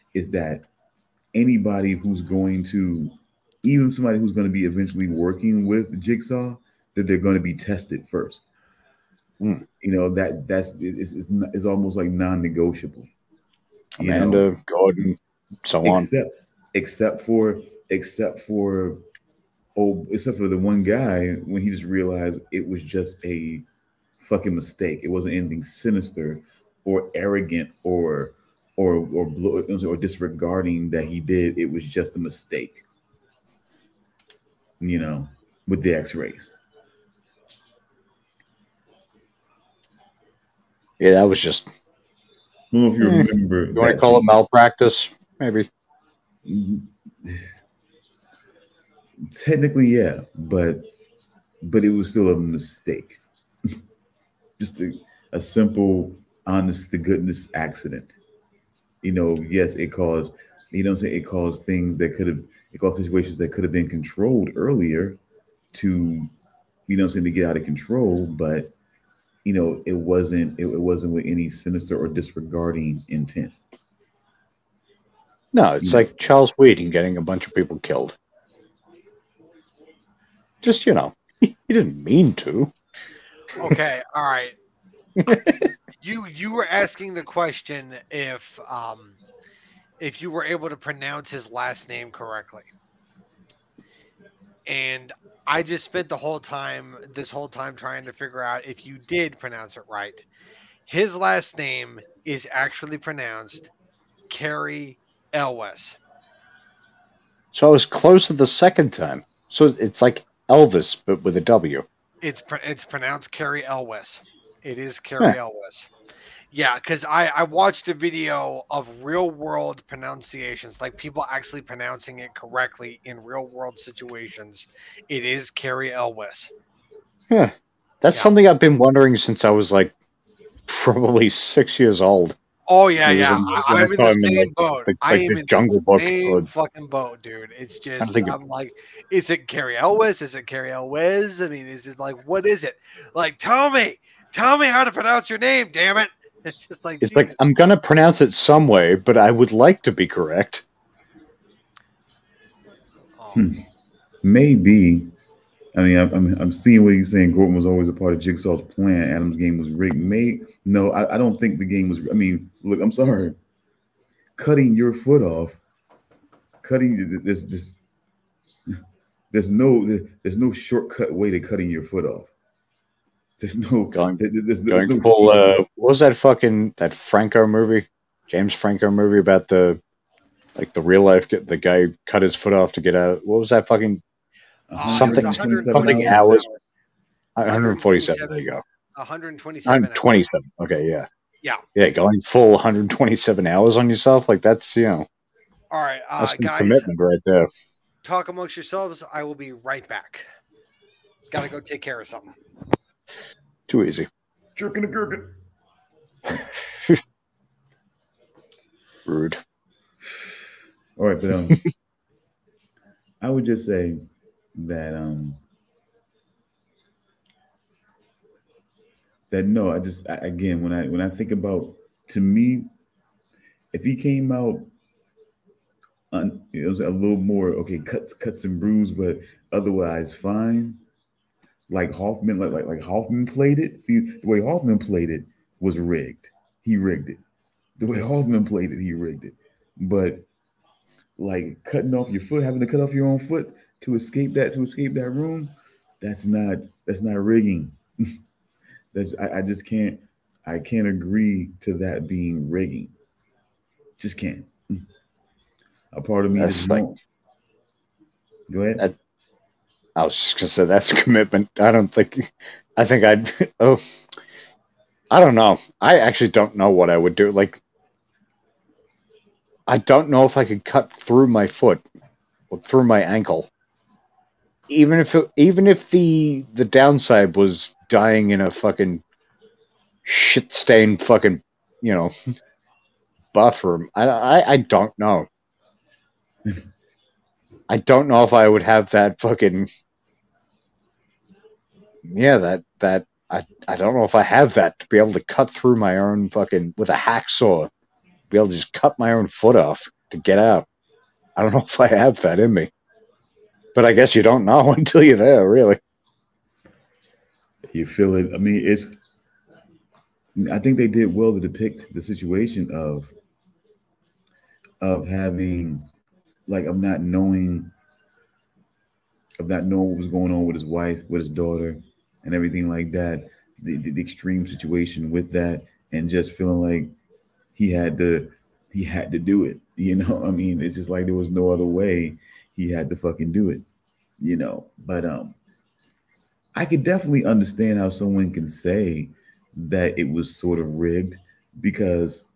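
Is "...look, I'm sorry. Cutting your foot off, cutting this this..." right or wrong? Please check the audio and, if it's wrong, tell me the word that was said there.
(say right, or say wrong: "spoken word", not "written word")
right.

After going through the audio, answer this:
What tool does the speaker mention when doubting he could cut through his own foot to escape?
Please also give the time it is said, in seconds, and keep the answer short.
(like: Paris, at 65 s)
hacksaw, at 296 s.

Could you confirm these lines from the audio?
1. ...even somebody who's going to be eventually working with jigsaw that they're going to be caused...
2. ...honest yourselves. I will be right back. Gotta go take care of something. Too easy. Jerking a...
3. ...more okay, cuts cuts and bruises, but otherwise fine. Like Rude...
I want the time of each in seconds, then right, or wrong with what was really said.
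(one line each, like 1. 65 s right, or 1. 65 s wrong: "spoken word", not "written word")
1. 3 s wrong: "tested", not "caused"
2. 198 s wrong: "amongst", not "honest"
3. 227 s wrong: "Hoffman", not "Rude".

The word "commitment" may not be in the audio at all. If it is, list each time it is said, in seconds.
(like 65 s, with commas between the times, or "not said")
196 s, 261 s.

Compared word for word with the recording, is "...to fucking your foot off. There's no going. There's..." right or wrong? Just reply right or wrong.
wrong.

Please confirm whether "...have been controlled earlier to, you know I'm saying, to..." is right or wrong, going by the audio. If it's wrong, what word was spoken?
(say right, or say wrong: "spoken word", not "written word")
right.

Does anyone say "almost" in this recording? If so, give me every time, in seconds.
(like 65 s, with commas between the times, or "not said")
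11 s.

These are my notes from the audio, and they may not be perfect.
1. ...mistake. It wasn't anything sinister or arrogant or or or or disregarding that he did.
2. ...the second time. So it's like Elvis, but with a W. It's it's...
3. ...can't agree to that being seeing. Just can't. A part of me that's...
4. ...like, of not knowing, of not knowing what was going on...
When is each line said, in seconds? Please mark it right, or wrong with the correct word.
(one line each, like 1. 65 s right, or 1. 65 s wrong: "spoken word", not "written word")
1. 24 s right
2. 108 s right
3. 250 s wrong: "rigging", not "seeing"
4. 316 s right.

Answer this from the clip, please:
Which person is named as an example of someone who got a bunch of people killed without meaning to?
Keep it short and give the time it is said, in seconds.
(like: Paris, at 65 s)
Charles Weeden, at 76 s.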